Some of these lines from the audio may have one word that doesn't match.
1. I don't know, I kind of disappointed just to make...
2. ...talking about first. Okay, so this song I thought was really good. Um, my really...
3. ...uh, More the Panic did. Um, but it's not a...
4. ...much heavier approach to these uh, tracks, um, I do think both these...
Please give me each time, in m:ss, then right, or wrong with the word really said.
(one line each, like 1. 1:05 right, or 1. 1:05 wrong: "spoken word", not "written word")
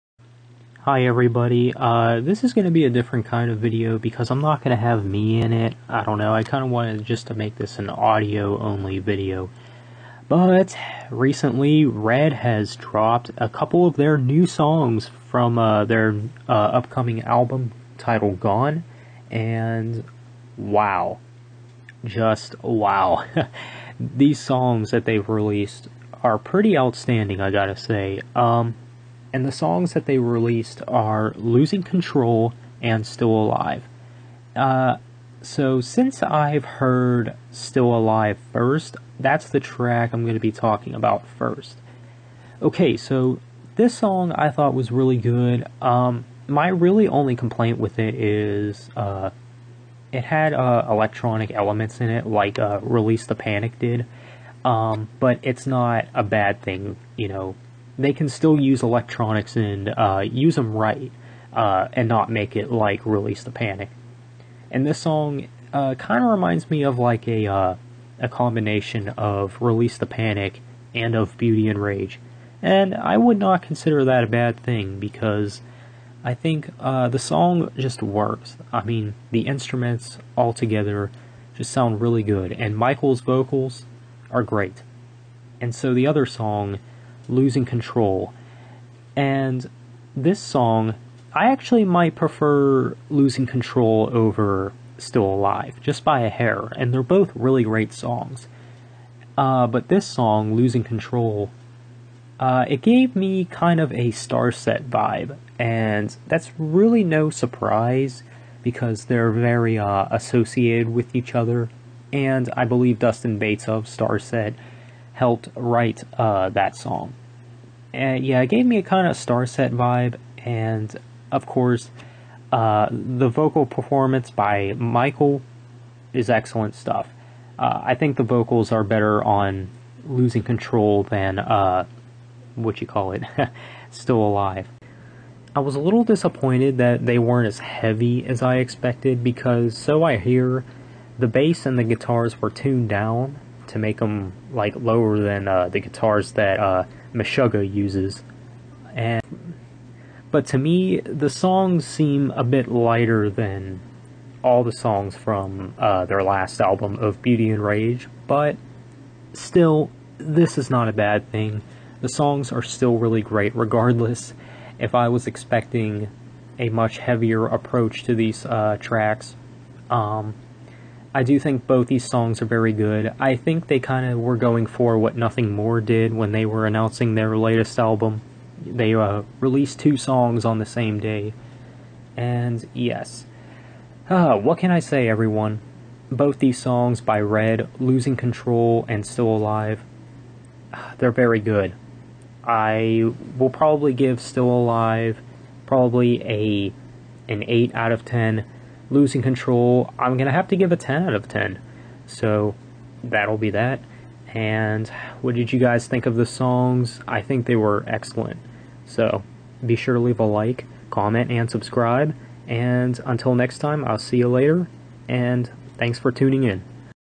1. 0:05 wrong: "wanted", not "disappointed"
2. 0:40 right
3. 0:52 wrong: "Release", not "More"
4. 2:46 right.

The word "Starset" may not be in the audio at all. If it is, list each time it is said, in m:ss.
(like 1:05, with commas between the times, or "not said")
1:44, 1:53, 1:59.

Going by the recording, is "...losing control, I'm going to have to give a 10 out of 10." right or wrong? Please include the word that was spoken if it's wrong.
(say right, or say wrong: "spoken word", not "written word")
right.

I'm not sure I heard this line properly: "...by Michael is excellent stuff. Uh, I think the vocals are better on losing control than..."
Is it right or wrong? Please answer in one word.
right.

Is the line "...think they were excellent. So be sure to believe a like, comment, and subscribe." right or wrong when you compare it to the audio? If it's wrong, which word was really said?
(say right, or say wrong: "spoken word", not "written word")
wrong: "leave", not "believe".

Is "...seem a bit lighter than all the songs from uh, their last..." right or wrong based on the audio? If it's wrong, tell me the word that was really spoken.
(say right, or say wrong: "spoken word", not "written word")
right.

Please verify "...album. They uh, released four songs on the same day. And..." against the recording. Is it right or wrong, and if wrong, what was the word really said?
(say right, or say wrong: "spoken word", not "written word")
wrong: "two", not "four".